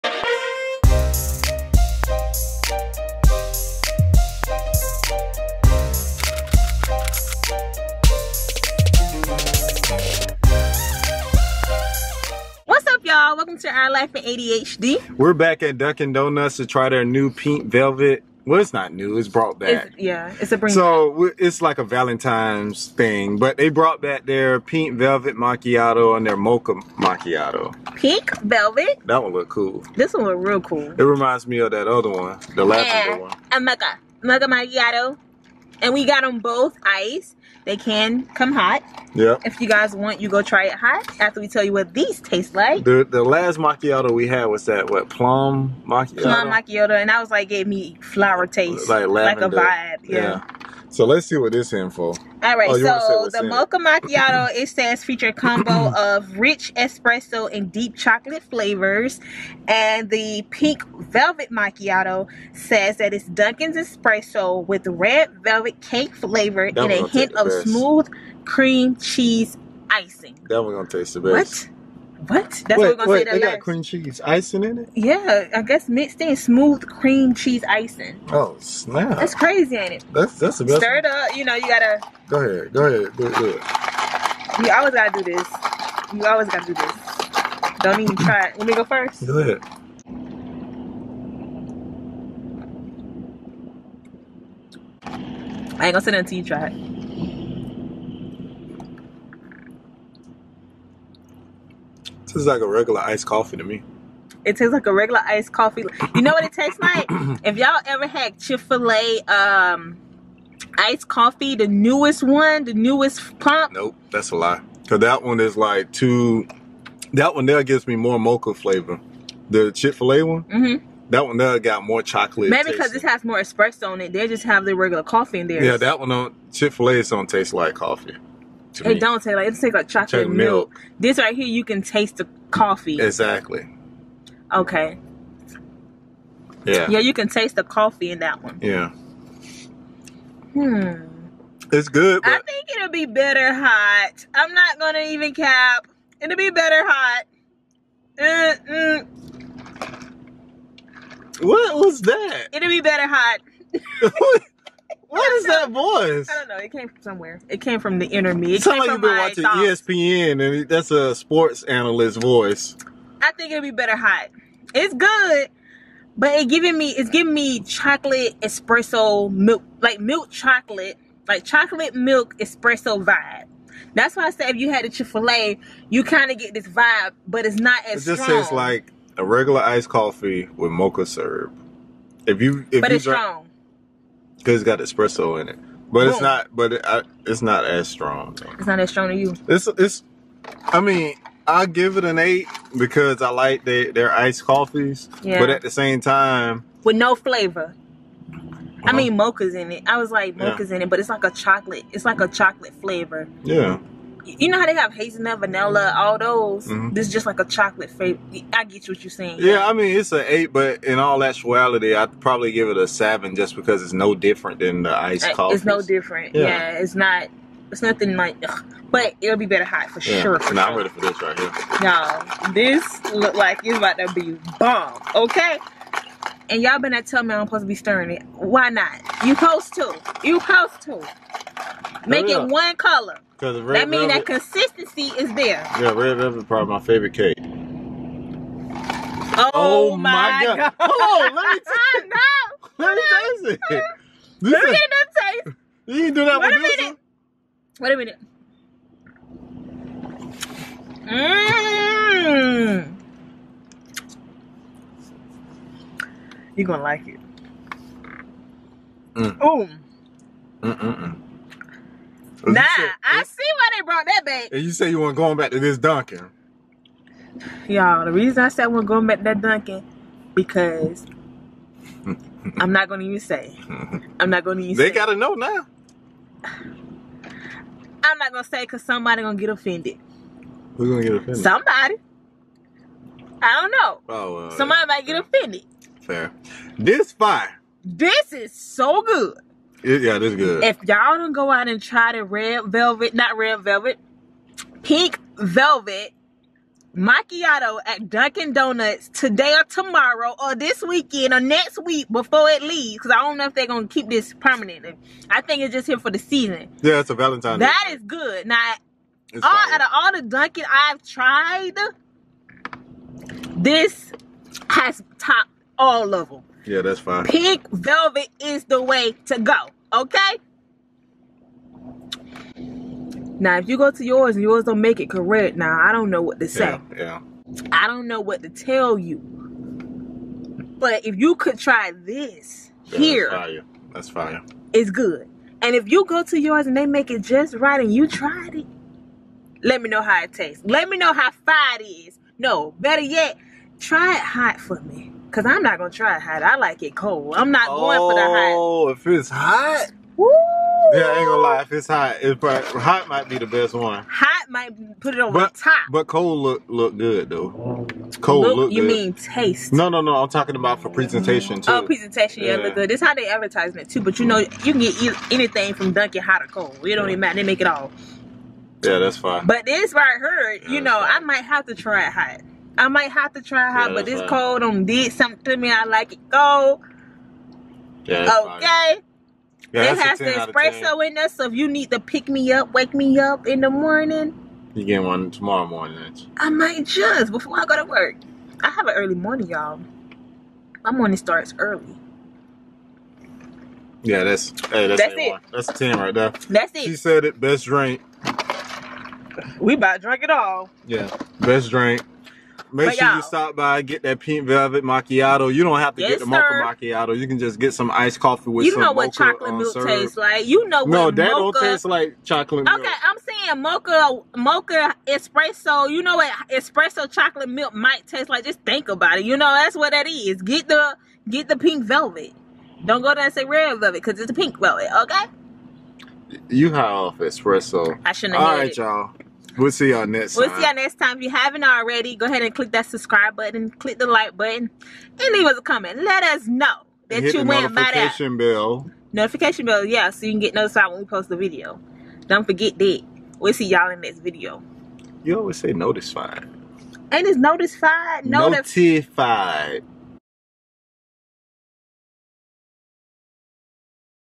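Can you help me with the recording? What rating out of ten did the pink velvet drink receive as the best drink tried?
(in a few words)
10.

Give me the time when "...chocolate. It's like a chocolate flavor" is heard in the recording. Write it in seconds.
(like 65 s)
201 s.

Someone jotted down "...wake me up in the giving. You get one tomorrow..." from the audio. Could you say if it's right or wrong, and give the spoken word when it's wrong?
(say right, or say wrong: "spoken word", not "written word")
wrong: "morning", not "giving".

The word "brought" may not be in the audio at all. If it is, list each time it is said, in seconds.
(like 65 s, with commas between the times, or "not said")
19 s, 23 s, 263 s.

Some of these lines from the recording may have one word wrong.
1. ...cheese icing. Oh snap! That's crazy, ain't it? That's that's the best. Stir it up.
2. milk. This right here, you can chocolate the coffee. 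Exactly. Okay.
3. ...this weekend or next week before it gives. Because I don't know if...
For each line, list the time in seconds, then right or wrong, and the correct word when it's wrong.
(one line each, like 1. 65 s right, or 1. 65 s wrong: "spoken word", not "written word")
1. 77 s right
2. 130 s wrong: "taste", not "chocolate"
3. 300 s wrong: "leaves", not "gives".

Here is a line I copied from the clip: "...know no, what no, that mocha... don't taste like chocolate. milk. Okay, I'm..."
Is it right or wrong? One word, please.
right.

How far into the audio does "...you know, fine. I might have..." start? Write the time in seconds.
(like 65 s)
370 s.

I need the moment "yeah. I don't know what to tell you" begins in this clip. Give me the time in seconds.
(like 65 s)
327 s.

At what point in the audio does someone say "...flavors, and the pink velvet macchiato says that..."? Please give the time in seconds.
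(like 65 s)
58 s.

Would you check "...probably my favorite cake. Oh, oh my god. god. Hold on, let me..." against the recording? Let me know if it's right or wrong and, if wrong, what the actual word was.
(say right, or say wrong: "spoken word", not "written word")
right.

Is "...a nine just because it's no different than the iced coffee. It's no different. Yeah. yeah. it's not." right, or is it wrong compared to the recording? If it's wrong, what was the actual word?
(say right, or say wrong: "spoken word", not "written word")
wrong: "seven", not "nine".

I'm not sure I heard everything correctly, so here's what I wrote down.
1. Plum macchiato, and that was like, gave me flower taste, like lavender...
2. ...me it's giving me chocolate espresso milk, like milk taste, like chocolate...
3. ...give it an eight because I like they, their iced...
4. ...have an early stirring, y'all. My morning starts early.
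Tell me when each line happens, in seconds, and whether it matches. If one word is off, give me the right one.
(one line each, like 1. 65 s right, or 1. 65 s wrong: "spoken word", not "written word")
1. 46 s right
2. 166 s wrong: "chocolate", not "taste"
3. 191 s right
4. 388 s wrong: "morning", not "stirring".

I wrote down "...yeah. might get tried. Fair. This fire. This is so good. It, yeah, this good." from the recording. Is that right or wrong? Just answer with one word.
wrong.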